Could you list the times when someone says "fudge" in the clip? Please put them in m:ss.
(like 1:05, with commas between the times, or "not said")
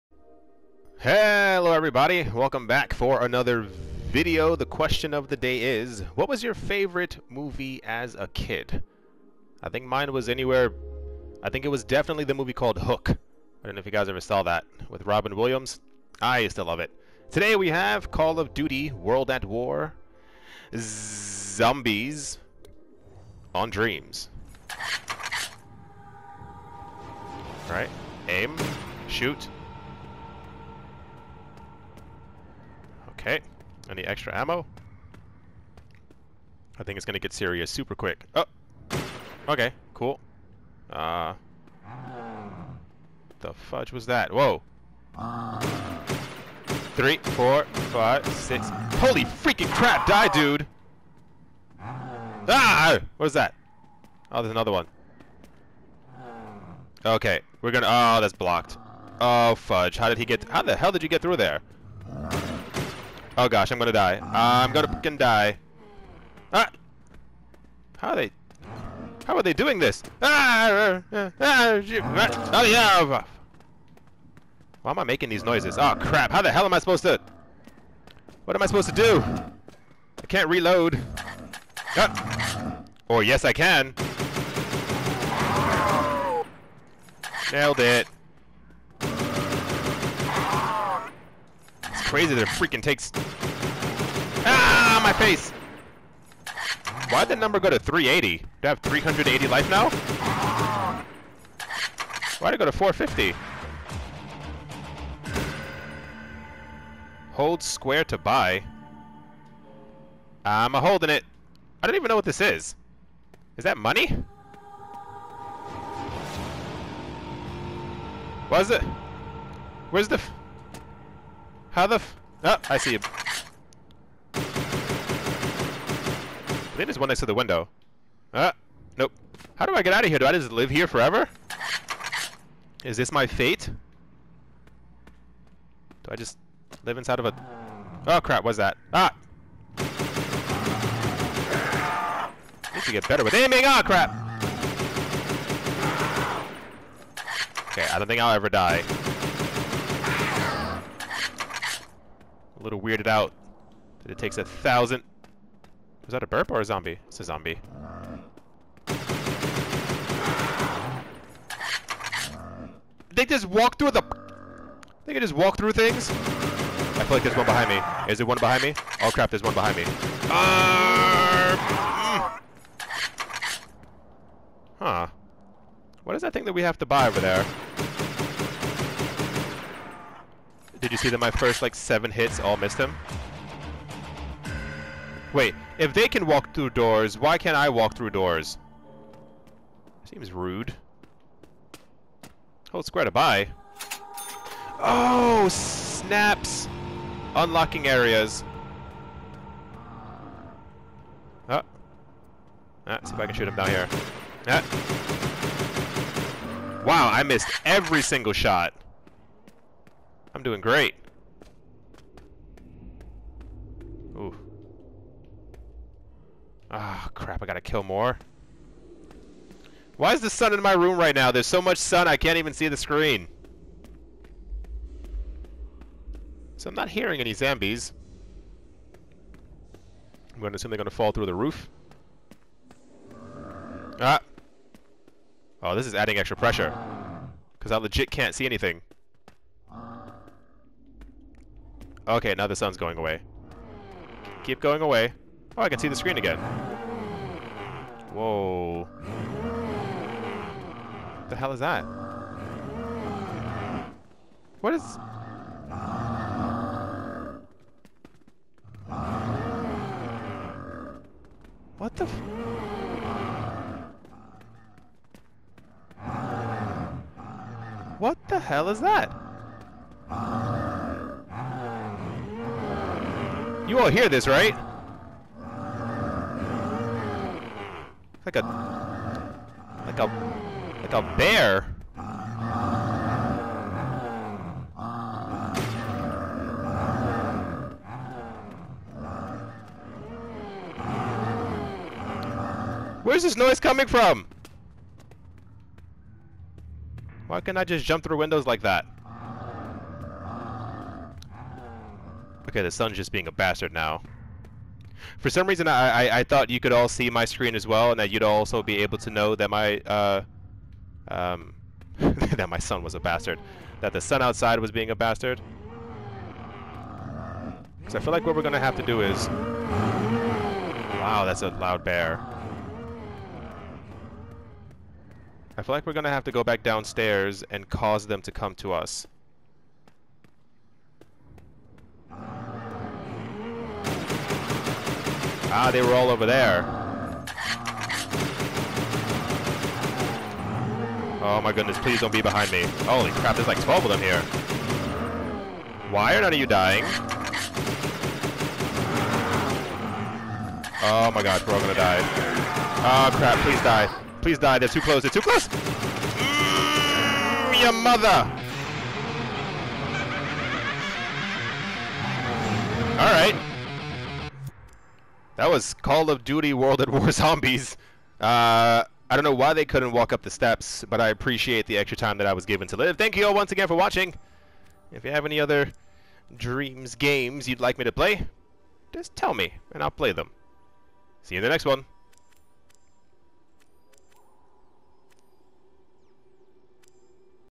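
0:43, 0:59.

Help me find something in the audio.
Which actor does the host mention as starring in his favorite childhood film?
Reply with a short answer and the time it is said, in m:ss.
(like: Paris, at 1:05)
Robin Williams, at 0:15.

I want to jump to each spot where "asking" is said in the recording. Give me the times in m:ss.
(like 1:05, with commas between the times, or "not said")
not said.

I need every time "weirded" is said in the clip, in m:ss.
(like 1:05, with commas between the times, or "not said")
2:32.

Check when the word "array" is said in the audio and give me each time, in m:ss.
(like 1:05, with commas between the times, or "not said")
not said.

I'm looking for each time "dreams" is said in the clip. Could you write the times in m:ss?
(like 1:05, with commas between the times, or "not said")
0:23, 6:16.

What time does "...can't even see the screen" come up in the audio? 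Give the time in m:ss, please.
3:42.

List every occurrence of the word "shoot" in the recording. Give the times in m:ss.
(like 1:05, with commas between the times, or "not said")
0:29, 3:23.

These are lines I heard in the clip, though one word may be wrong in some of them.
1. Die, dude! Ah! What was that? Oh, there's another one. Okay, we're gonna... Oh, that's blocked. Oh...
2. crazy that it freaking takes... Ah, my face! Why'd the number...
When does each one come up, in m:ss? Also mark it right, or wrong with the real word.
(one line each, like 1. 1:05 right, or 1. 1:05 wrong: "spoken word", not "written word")
1. 0:50 right
2. 1:32 right.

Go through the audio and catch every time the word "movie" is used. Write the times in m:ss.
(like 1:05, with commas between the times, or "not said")
0:07, 0:12.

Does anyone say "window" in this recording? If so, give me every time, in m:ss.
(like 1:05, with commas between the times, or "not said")
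2:07, 4:58.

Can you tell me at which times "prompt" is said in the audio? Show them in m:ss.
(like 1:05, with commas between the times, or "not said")
not said.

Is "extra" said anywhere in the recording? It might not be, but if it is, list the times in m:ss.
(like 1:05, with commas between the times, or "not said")
0:34, 3:56, 6:11.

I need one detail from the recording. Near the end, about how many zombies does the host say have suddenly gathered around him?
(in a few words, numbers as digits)
12.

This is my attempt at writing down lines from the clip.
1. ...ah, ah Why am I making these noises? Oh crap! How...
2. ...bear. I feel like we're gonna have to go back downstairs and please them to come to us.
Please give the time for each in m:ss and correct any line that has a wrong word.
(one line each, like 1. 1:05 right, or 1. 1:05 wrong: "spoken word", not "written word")
1. 1:12 right
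2. 5:21 wrong: "cause", not "please".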